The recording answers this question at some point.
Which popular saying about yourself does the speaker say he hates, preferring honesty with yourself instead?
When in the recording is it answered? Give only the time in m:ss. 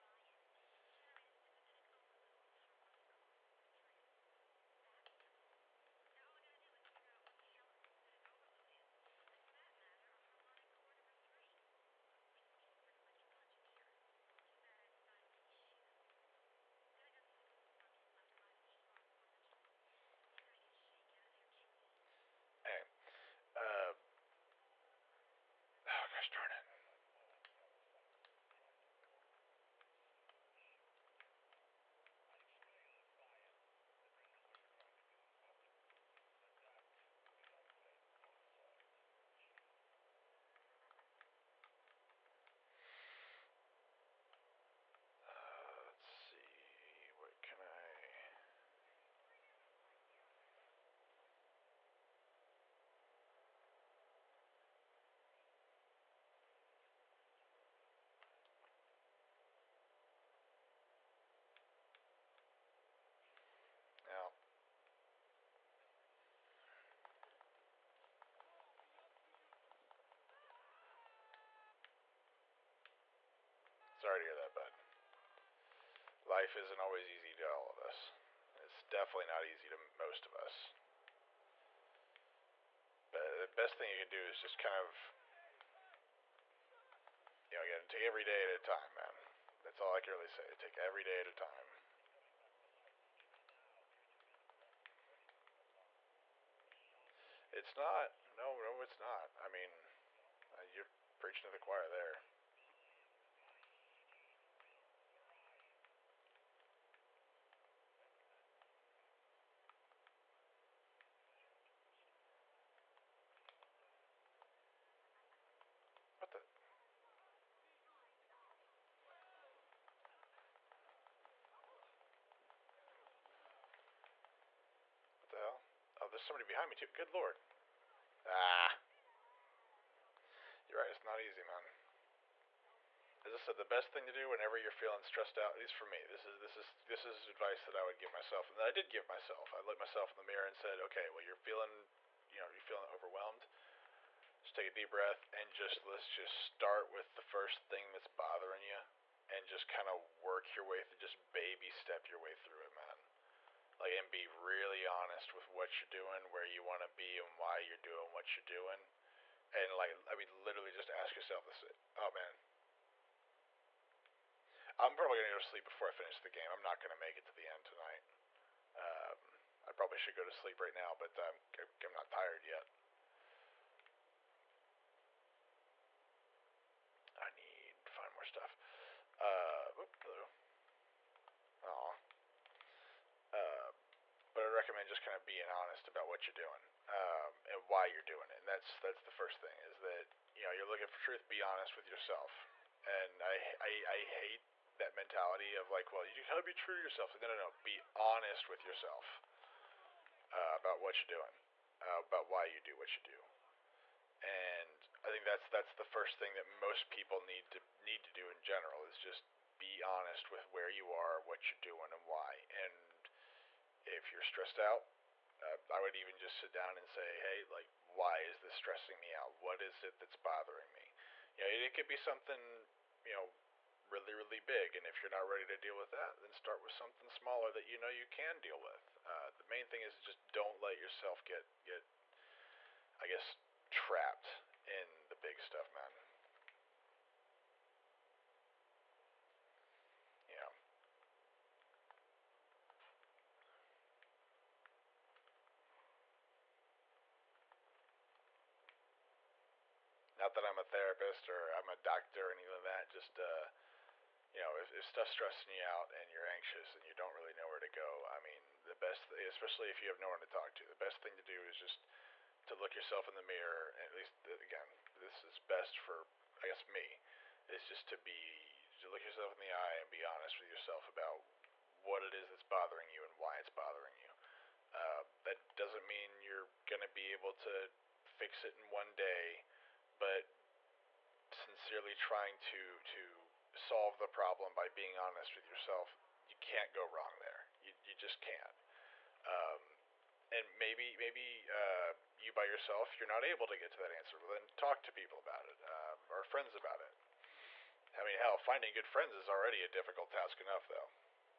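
3:16.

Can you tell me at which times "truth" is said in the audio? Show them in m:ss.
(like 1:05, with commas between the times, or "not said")
3:10.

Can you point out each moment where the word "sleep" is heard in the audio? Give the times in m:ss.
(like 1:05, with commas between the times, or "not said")
2:45, 2:50.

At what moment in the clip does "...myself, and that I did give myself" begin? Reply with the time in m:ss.
2:18.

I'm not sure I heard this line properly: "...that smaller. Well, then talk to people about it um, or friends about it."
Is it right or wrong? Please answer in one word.
wrong.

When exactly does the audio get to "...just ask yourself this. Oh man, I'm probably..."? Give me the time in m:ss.
2:40.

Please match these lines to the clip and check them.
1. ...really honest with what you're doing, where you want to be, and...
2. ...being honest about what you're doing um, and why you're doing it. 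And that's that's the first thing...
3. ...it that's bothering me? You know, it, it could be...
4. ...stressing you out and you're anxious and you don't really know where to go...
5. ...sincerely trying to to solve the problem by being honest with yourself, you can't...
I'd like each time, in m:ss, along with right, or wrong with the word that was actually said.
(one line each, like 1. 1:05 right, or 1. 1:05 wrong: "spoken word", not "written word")
1. 2:34 right
2. 3:05 right
3. 3:39 right
4. 4:15 right
5. 4:41 right.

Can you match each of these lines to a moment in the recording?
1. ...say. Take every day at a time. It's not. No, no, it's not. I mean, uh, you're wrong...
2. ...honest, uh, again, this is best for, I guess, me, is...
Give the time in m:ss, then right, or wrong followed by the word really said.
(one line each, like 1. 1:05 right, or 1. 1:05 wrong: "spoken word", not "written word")
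1. 1:30 wrong: "preaching", not "wrong"
2. 4:23 wrong: "least", not "honest".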